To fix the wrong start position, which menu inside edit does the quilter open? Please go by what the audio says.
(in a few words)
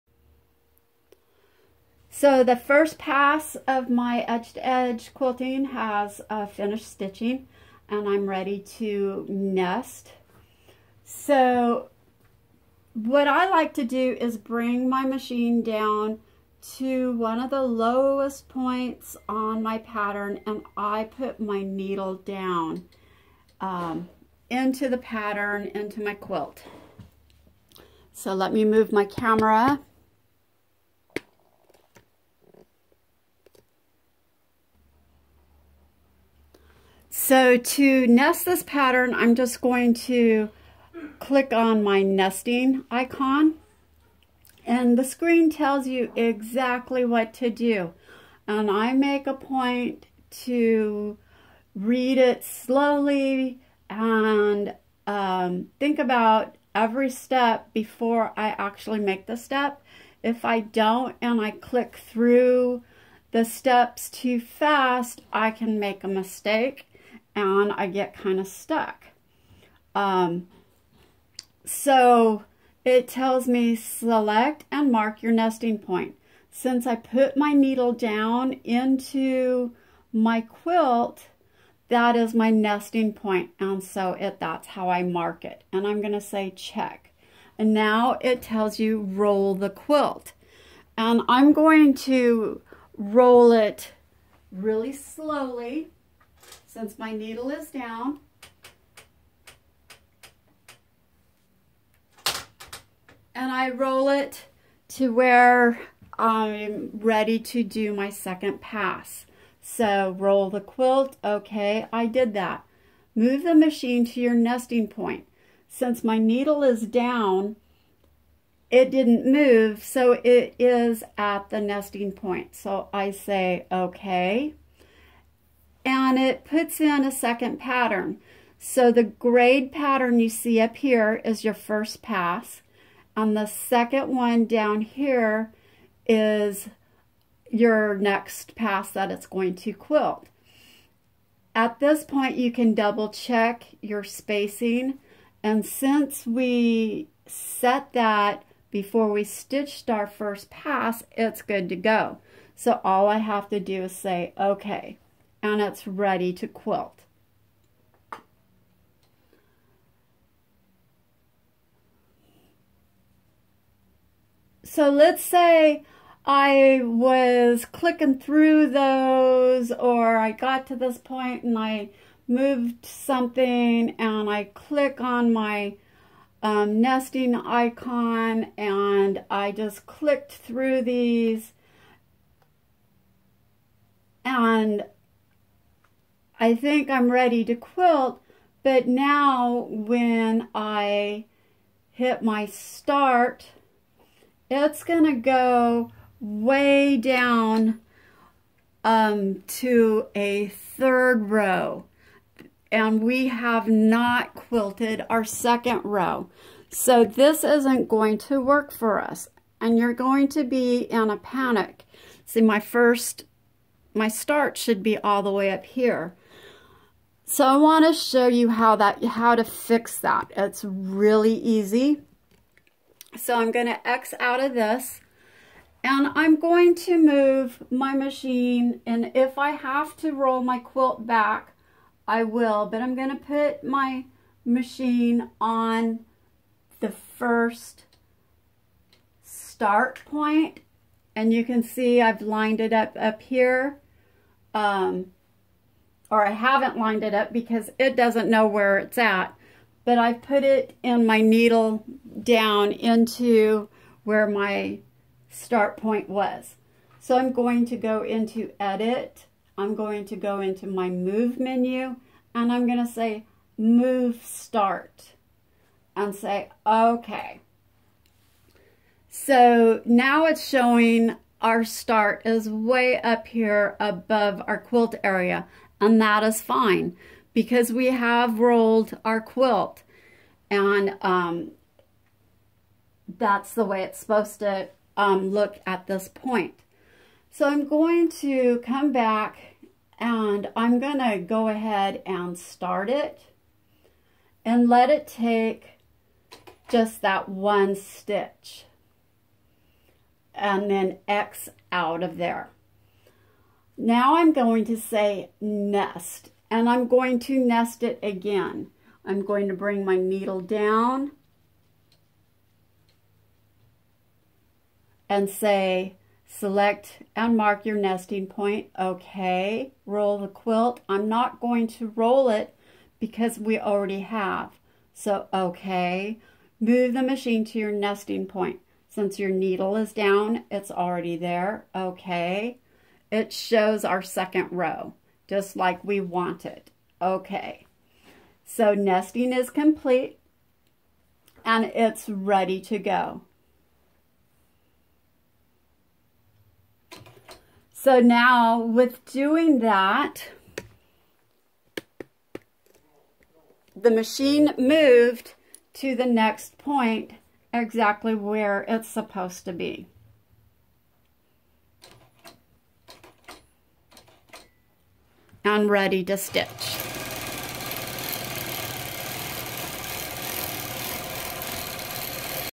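Move menu.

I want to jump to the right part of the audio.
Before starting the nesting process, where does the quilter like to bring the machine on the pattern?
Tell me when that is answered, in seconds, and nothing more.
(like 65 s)
17 s.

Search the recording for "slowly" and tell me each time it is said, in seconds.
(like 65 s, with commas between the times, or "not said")
52 s, 94 s.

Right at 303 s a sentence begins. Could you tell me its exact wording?
Now I'm going to say nest, and I'm going to nest it again.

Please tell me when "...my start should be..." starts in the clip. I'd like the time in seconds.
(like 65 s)
213 s.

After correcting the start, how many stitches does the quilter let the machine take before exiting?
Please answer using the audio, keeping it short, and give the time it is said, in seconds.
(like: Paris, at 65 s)
1, at 297 s.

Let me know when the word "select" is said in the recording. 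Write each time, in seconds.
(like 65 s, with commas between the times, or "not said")
73 s, 316 s.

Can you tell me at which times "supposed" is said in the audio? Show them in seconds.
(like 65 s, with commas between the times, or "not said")
283 s, 358 s.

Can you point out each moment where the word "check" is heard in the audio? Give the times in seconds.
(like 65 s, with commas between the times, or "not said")
86 s, 143 s.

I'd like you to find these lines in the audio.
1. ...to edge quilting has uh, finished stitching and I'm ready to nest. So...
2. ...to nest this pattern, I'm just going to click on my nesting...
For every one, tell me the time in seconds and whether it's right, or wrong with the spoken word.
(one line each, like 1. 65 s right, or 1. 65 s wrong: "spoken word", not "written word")
1. 4 s right
2. 37 s right.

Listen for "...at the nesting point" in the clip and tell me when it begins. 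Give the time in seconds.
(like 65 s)
121 s.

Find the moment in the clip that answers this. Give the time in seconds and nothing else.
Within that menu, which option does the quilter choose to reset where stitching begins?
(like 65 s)
263 s.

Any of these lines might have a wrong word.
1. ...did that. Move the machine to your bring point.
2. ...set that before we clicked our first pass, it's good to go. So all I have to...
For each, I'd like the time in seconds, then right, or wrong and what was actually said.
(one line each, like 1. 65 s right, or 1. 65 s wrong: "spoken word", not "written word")
1. 112 s wrong: "nesting", not "bring"
2. 147 s wrong: "stitched", not "clicked".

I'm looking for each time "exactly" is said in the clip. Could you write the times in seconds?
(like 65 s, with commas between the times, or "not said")
46 s, 357 s.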